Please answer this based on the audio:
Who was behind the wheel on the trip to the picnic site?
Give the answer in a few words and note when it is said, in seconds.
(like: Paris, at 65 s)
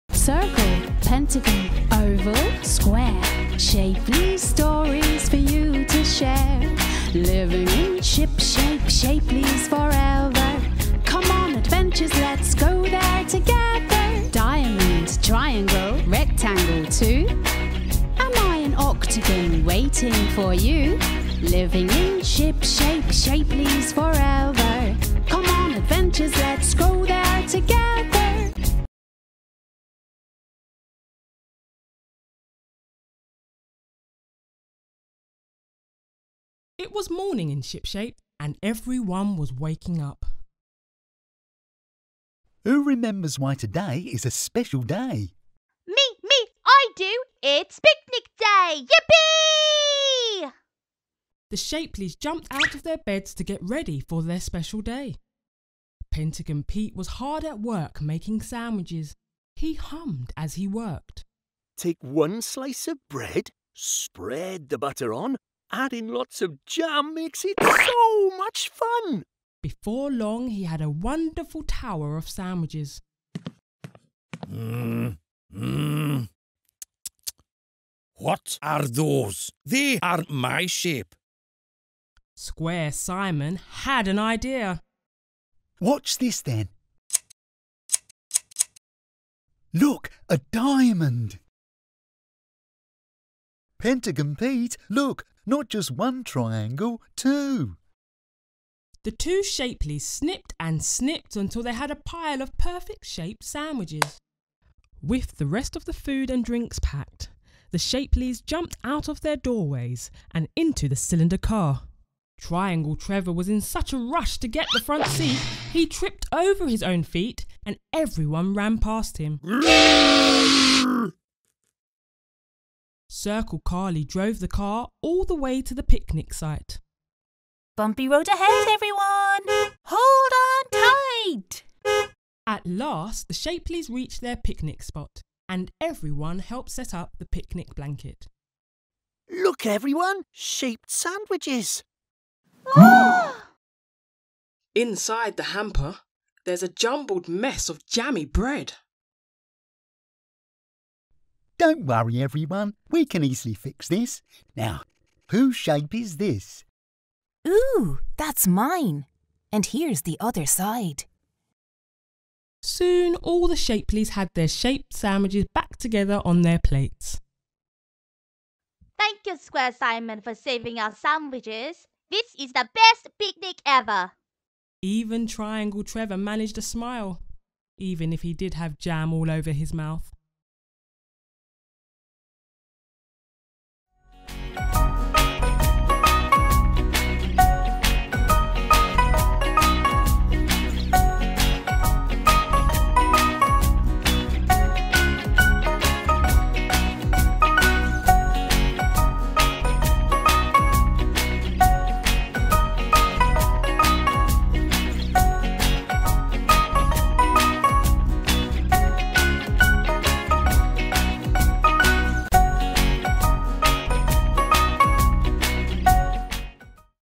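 Circle Carly, at 123 s.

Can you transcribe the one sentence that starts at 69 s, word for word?
Before long, he had a wonderful tower of sandwiches.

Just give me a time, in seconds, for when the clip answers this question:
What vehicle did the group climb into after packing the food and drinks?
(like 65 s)
110 s.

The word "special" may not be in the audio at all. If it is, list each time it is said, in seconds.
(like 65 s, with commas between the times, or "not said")
44 s, 54 s.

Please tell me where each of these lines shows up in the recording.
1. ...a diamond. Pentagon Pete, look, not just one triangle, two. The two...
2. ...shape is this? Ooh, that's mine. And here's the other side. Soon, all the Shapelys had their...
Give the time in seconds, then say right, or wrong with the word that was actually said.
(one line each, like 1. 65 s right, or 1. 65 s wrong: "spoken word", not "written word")
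1. 90 s right
2. 155 s right.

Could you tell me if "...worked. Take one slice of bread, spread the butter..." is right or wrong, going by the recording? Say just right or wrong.
right.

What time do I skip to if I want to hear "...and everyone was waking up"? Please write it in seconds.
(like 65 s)
38 s.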